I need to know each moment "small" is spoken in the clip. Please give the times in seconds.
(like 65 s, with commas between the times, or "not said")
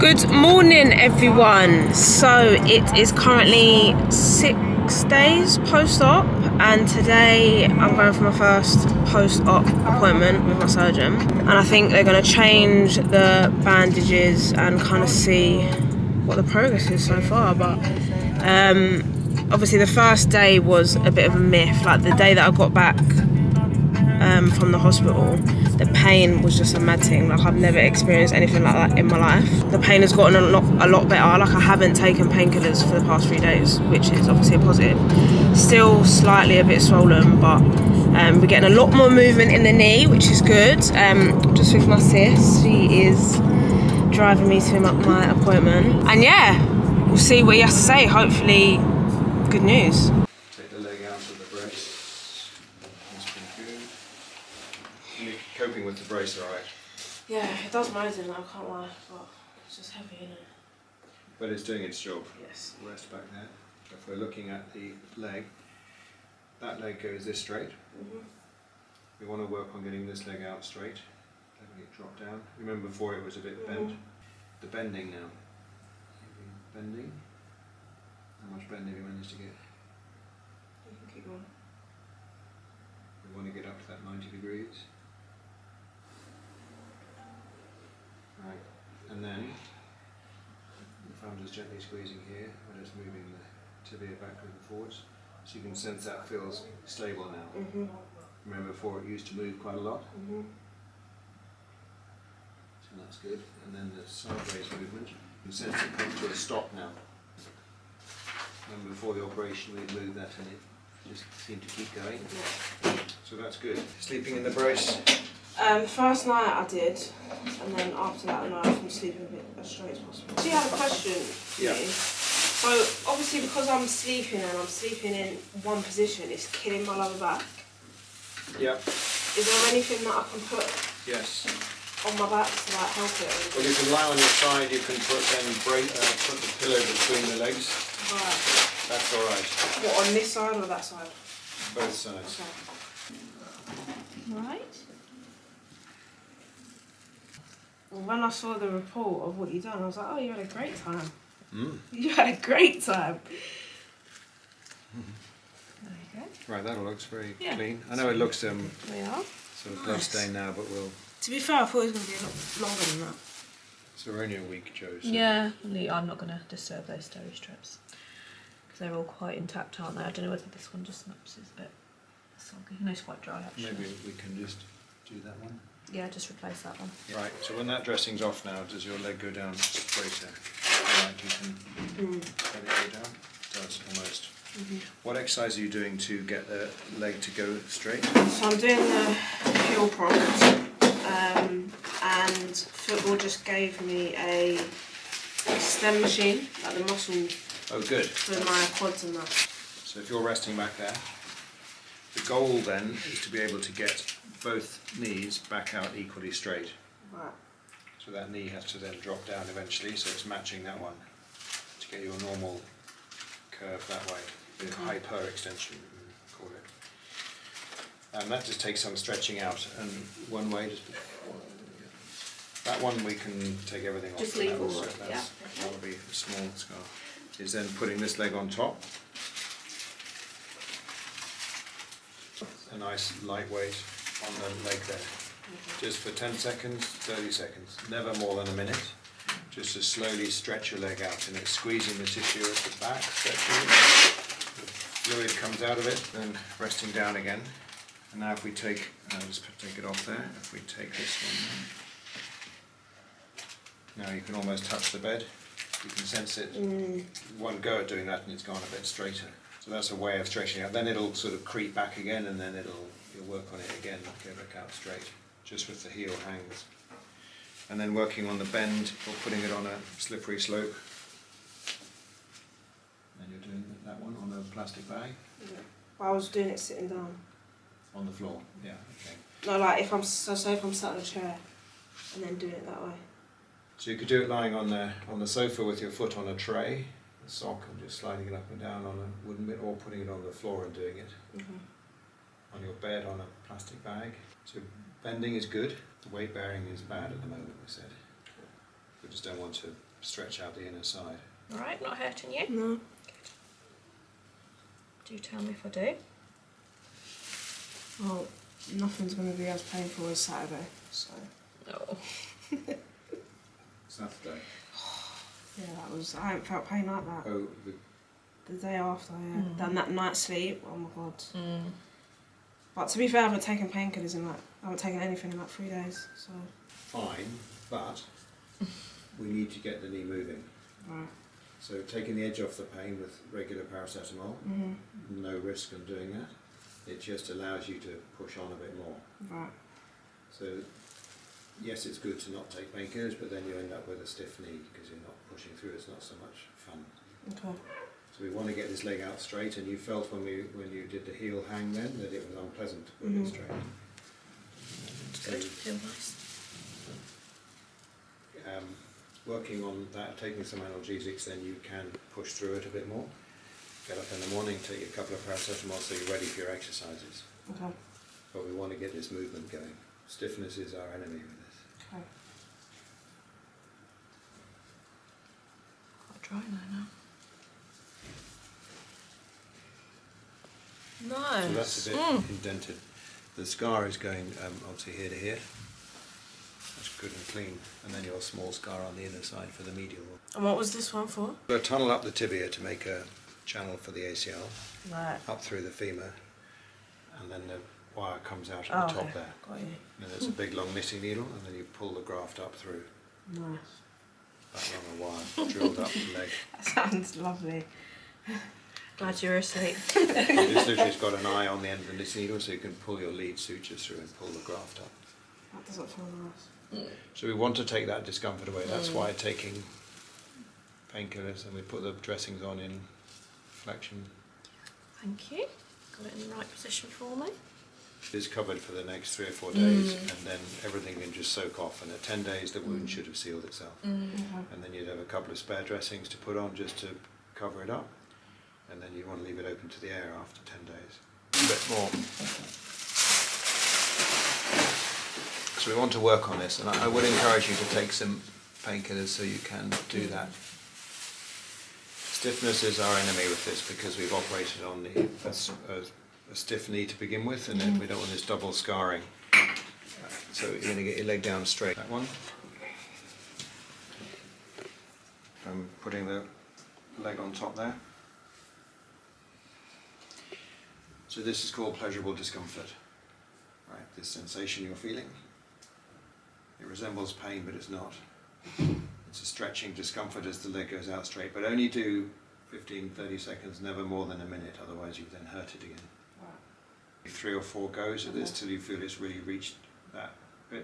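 226 s, 388 s.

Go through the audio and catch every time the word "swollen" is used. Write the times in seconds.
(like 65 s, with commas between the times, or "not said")
36 s.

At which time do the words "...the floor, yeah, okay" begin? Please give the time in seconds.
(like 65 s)
278 s.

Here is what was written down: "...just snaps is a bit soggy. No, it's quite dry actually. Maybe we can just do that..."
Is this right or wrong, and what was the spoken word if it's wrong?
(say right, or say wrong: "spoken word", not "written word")
right.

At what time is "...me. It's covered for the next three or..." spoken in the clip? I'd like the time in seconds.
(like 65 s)
427 s.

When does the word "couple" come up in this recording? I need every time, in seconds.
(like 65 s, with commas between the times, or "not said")
364 s, 435 s.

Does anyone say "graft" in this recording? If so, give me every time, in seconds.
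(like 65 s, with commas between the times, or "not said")
402 s, 414 s.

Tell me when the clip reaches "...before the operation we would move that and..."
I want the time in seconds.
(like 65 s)
108 s.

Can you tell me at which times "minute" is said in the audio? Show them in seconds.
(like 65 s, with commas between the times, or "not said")
238 s, 484 s.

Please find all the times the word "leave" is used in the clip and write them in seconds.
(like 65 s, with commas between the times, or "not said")
224 s, 439 s.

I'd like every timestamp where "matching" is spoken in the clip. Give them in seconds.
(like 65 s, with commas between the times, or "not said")
210 s.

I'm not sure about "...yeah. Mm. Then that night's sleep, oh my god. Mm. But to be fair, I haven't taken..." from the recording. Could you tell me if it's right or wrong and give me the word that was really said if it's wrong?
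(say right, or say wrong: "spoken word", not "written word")
right.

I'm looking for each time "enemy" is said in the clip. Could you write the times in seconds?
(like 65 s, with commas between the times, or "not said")
370 s, 452 s.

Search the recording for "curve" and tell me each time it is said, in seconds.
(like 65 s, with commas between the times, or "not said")
213 s.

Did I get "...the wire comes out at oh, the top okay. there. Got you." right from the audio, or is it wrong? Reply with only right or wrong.
right.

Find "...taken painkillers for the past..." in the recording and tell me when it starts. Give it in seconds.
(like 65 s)
31 s.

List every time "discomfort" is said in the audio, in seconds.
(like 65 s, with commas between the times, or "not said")
418 s, 472 s, 479 s.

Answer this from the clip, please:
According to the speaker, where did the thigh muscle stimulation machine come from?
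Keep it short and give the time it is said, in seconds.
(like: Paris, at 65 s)
Football, at 192 s.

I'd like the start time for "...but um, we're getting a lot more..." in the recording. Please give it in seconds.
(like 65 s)
37 s.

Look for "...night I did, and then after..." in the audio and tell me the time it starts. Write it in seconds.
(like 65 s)
116 s.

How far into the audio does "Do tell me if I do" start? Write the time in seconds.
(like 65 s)
305 s.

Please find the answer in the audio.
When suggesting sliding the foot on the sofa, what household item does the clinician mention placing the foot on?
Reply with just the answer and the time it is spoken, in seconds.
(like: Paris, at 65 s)
A tray, at 286 s.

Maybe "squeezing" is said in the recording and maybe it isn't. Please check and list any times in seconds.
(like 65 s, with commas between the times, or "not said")
91 s, 241 s.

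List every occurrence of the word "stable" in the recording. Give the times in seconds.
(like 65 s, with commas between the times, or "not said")
96 s.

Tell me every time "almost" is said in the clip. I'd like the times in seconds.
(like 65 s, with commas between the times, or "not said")
183 s, 254 s.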